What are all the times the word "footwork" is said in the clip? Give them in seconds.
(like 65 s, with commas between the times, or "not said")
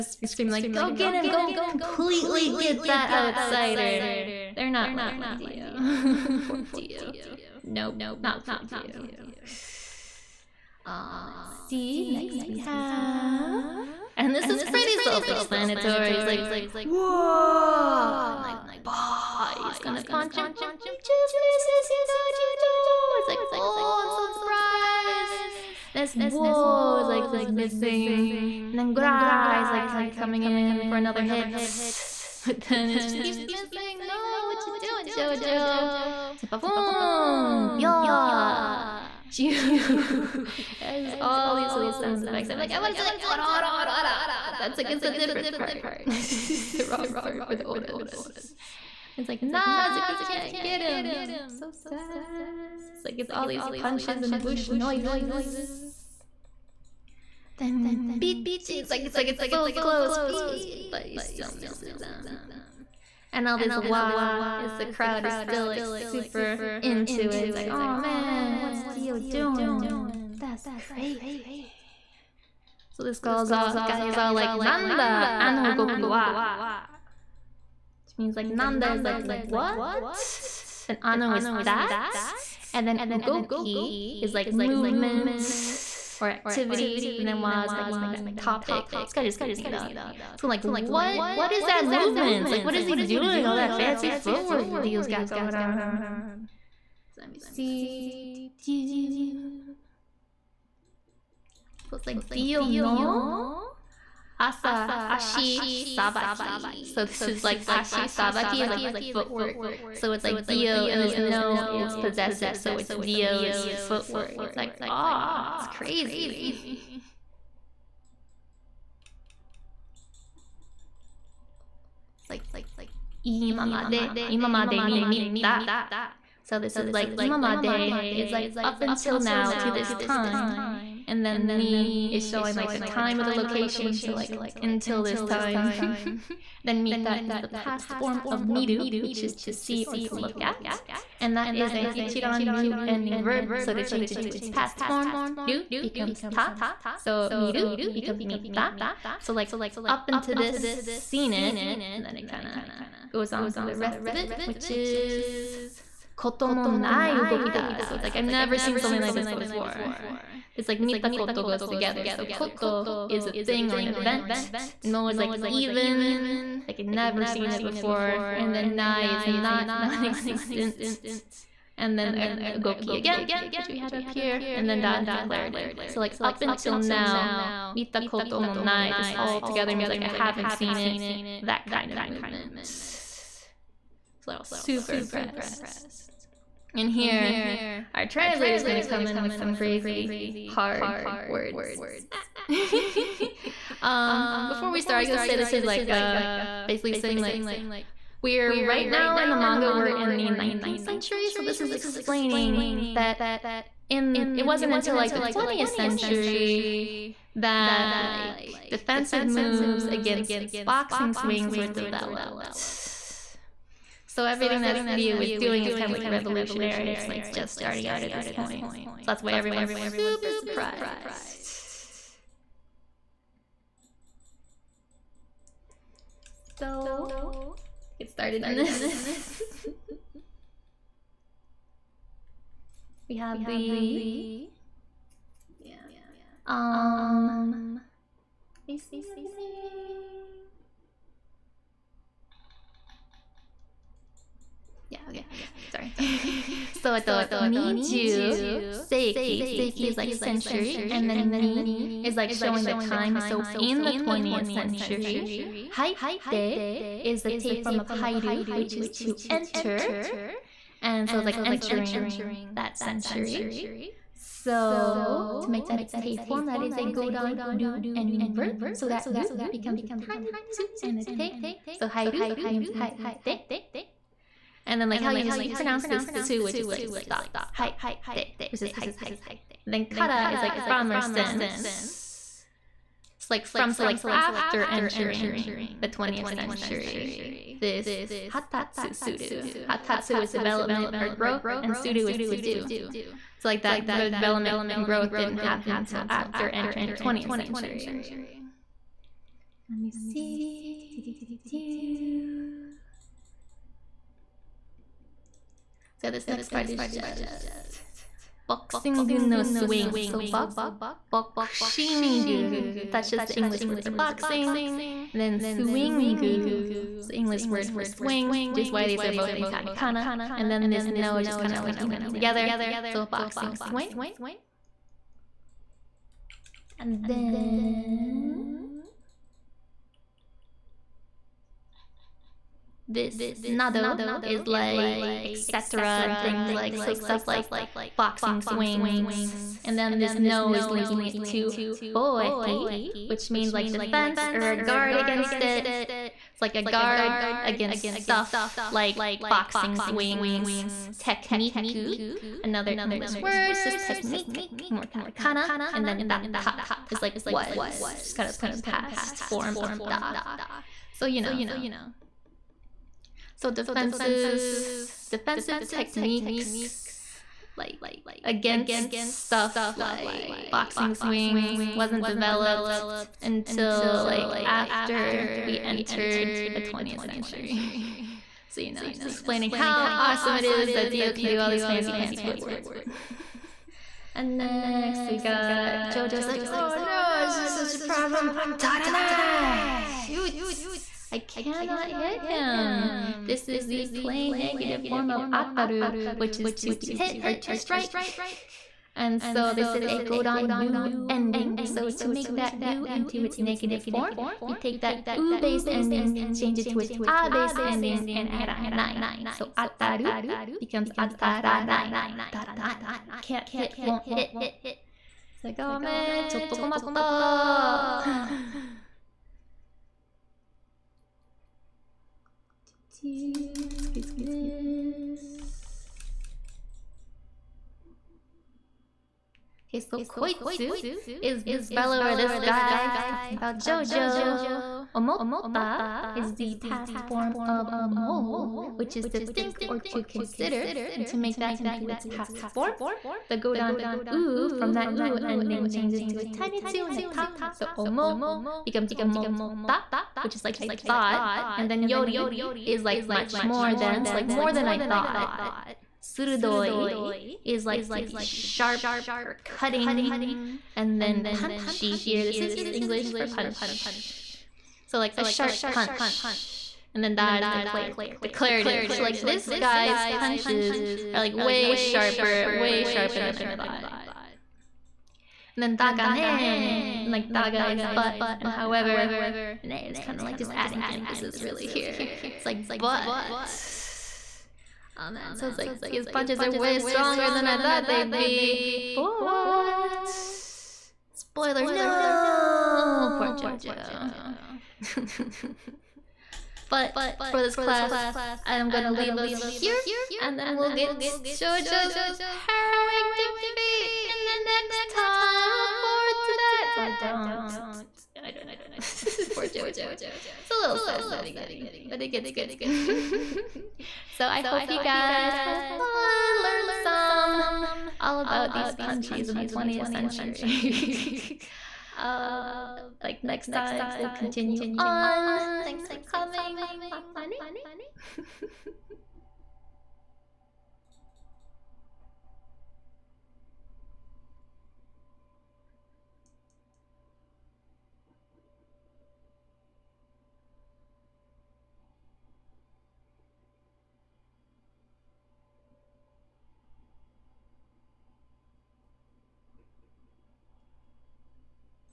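94 s, 109 s, 113 s, 382 s.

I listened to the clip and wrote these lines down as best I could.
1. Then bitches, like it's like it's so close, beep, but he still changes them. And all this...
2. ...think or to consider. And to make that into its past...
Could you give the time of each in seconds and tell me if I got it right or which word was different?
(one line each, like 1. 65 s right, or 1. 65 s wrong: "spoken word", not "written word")
1. 57 s wrong: "misses", not "changes"
2. 439 s right.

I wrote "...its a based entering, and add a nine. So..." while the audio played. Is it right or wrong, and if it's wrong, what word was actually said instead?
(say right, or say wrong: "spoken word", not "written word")
wrong: "ending", not "entering".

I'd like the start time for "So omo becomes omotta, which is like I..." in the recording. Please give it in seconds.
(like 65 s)
447 s.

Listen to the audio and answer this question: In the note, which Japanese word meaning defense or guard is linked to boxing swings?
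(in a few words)
boeki.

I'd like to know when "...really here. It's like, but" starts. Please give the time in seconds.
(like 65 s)
481 s.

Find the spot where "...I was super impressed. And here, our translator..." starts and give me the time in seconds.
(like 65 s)
184 s.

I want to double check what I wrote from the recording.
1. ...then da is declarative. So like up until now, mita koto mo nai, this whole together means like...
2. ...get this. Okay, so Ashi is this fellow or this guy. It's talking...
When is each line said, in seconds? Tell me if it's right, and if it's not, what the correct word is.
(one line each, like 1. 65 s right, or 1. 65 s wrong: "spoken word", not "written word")
1. 174 s right
2. 423 s wrong: "Koitsu", not "Ashi".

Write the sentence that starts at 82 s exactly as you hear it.
And then Ugoki is like movement or activity.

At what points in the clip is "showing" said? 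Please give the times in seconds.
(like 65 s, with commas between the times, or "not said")
132 s, 252 s.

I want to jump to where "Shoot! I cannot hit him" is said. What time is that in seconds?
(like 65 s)
389 s.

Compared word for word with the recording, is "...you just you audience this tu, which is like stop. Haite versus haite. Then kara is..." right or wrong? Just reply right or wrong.
wrong.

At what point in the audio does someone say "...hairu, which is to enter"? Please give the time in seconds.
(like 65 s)
257 s.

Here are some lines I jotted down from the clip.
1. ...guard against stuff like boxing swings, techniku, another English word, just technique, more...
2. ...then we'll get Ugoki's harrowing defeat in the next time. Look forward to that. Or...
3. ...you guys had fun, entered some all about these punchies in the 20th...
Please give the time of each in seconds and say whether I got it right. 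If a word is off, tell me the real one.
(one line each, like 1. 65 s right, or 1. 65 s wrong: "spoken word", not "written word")
1. 346 s right
2. 500 s wrong: "JoJo", not "Ugoki"
3. 514 s wrong: "learned", not "entered".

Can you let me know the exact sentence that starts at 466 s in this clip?
And then that is declar declarative.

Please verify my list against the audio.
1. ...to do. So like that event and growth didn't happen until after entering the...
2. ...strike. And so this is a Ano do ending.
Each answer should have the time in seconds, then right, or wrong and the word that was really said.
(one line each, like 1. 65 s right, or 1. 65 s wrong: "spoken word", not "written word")
1. 292 s wrong: "development", not "event"
2. 397 s wrong: "Godan", not "Ano".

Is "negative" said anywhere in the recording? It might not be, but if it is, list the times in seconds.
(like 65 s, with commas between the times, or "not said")
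394 s, 403 s.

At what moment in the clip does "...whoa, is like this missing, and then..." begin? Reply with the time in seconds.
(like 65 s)
26 s.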